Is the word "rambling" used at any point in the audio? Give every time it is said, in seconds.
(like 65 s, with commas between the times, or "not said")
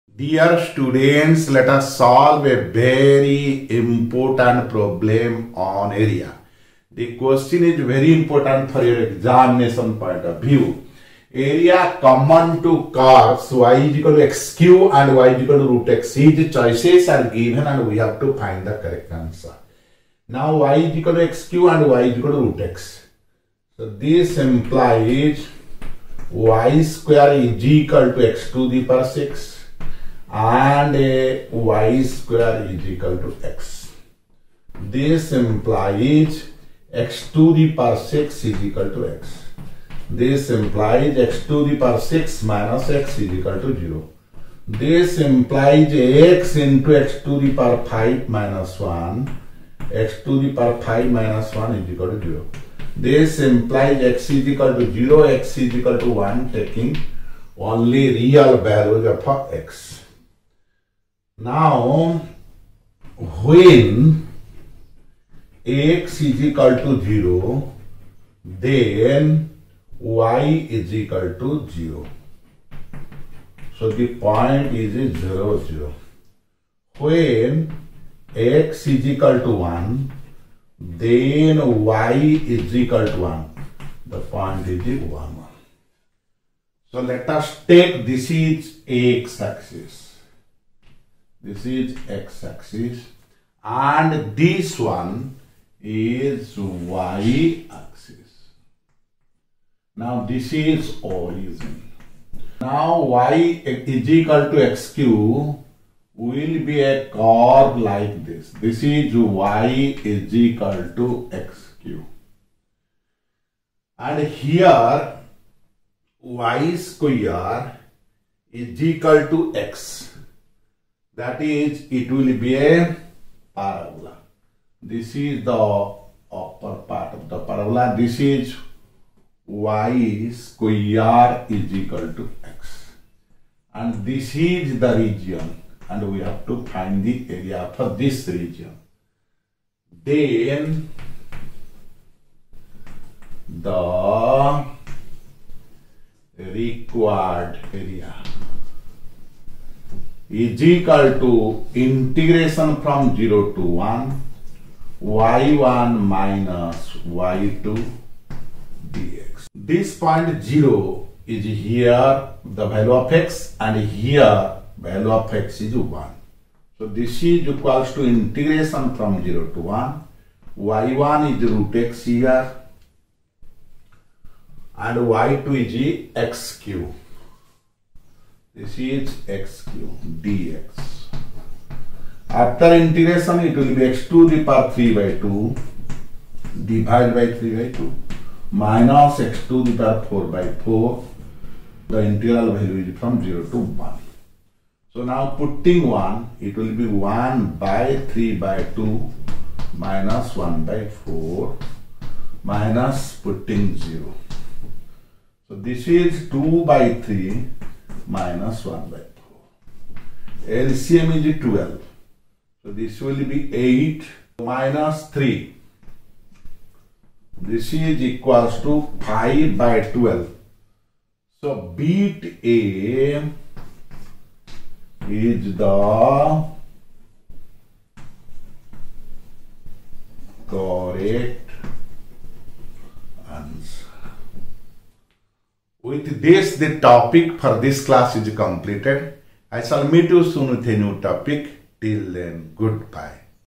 not said.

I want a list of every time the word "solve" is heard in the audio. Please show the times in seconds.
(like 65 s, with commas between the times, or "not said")
1 s.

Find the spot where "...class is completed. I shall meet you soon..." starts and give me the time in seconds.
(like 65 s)
237 s.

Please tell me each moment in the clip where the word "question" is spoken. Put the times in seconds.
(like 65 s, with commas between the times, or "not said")
7 s.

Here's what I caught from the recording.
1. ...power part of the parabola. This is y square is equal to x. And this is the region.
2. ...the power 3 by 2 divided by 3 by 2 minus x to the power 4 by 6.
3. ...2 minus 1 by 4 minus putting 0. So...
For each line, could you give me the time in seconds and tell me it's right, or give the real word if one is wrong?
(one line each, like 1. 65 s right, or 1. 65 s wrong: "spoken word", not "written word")
1. 126 s wrong: "upper", not "power"
2. 184 s wrong: "4", not "6"
3. 198 s right.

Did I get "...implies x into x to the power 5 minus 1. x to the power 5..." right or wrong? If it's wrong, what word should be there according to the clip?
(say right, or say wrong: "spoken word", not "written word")
right.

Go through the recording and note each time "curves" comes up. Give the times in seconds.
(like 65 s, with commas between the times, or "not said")
12 s, 107 s.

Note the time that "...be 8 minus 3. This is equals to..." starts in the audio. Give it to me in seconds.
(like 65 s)
213 s.